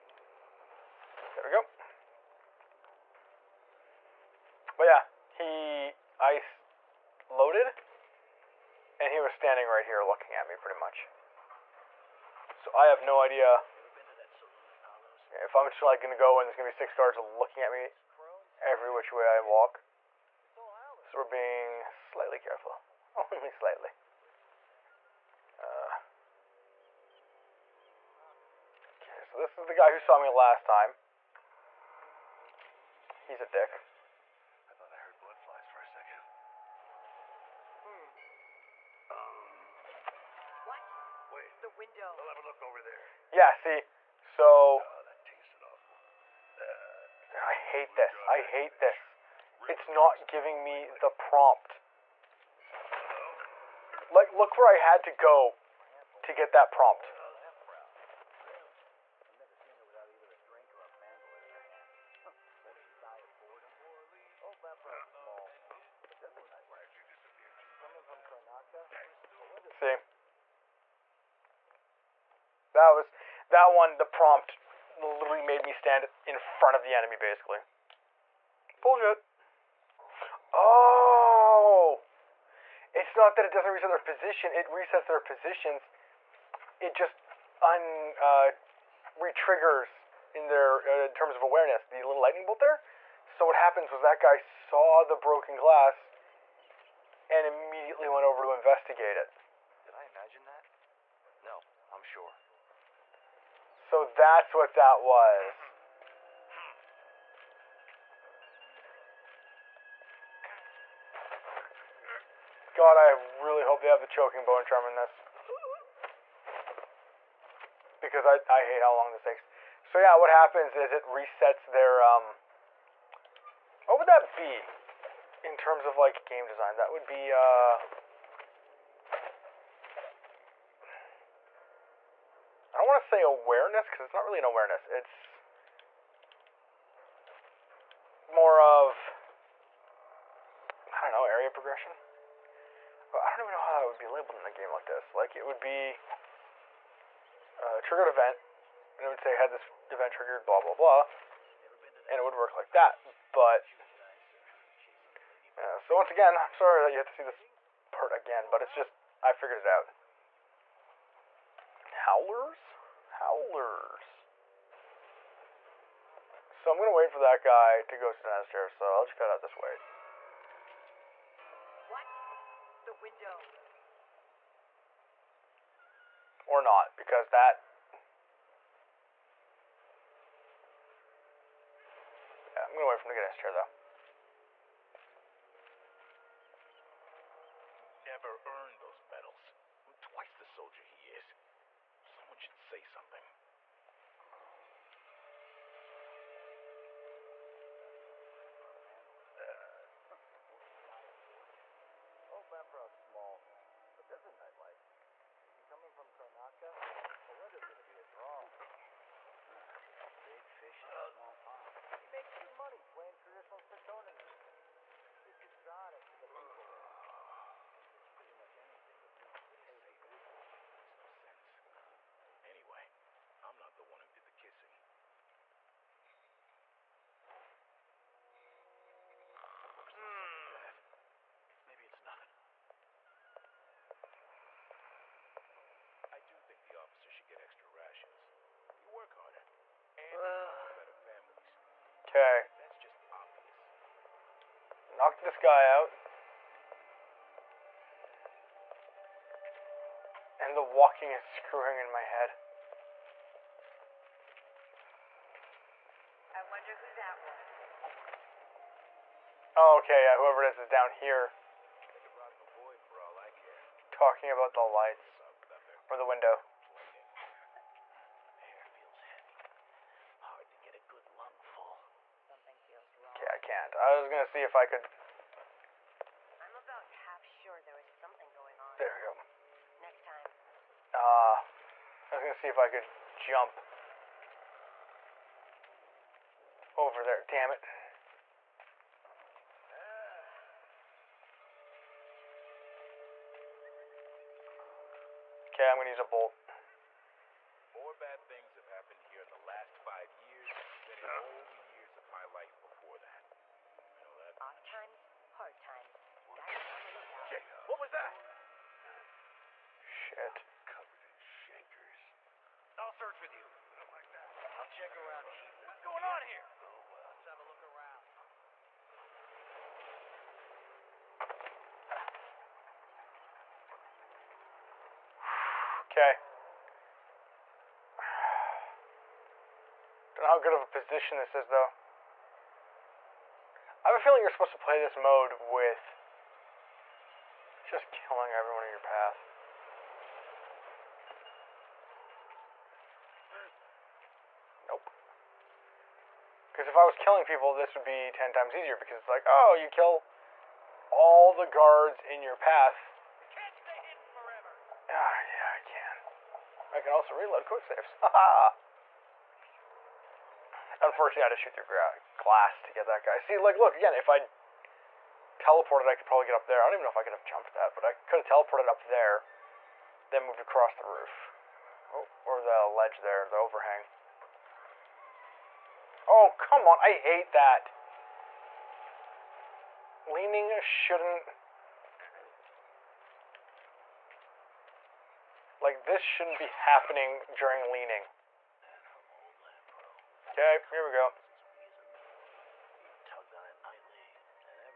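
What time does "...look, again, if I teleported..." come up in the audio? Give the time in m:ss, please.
6:03.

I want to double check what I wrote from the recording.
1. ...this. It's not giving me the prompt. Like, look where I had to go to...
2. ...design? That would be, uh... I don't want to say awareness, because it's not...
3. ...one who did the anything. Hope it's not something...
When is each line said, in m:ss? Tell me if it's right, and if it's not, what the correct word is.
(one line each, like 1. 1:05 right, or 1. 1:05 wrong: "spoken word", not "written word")
1. 0:48 right
2. 2:06 right
3. 3:43 wrong: "kissing", not "anything".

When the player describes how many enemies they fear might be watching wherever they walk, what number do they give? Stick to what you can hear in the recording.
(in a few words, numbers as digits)
6.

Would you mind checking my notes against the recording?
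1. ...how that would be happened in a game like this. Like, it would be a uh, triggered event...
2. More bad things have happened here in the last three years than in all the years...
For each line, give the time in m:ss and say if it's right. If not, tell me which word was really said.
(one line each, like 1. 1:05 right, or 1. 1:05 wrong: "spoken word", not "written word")
1. 2:23 wrong: "labeled", not "happened"
2. 4:57 wrong: "five", not "three".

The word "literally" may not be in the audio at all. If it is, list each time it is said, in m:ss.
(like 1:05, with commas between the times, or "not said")
1:14.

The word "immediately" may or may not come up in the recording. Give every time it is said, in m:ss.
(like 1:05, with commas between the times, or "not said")
1:37.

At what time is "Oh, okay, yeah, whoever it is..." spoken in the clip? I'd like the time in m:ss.
4:19.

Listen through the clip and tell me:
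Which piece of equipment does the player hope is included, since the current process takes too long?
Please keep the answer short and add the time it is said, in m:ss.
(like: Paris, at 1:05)
choking bow and charm, at 1:54.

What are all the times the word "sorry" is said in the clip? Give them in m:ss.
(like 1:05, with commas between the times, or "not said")
2:36.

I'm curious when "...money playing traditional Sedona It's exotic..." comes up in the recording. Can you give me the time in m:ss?
3:32.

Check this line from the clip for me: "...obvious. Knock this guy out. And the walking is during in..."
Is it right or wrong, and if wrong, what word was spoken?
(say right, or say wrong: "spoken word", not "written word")
wrong: "screwing", not "during".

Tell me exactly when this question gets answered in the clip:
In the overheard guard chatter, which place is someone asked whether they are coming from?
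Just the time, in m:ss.
3:26.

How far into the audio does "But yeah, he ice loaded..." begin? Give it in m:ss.
0:04.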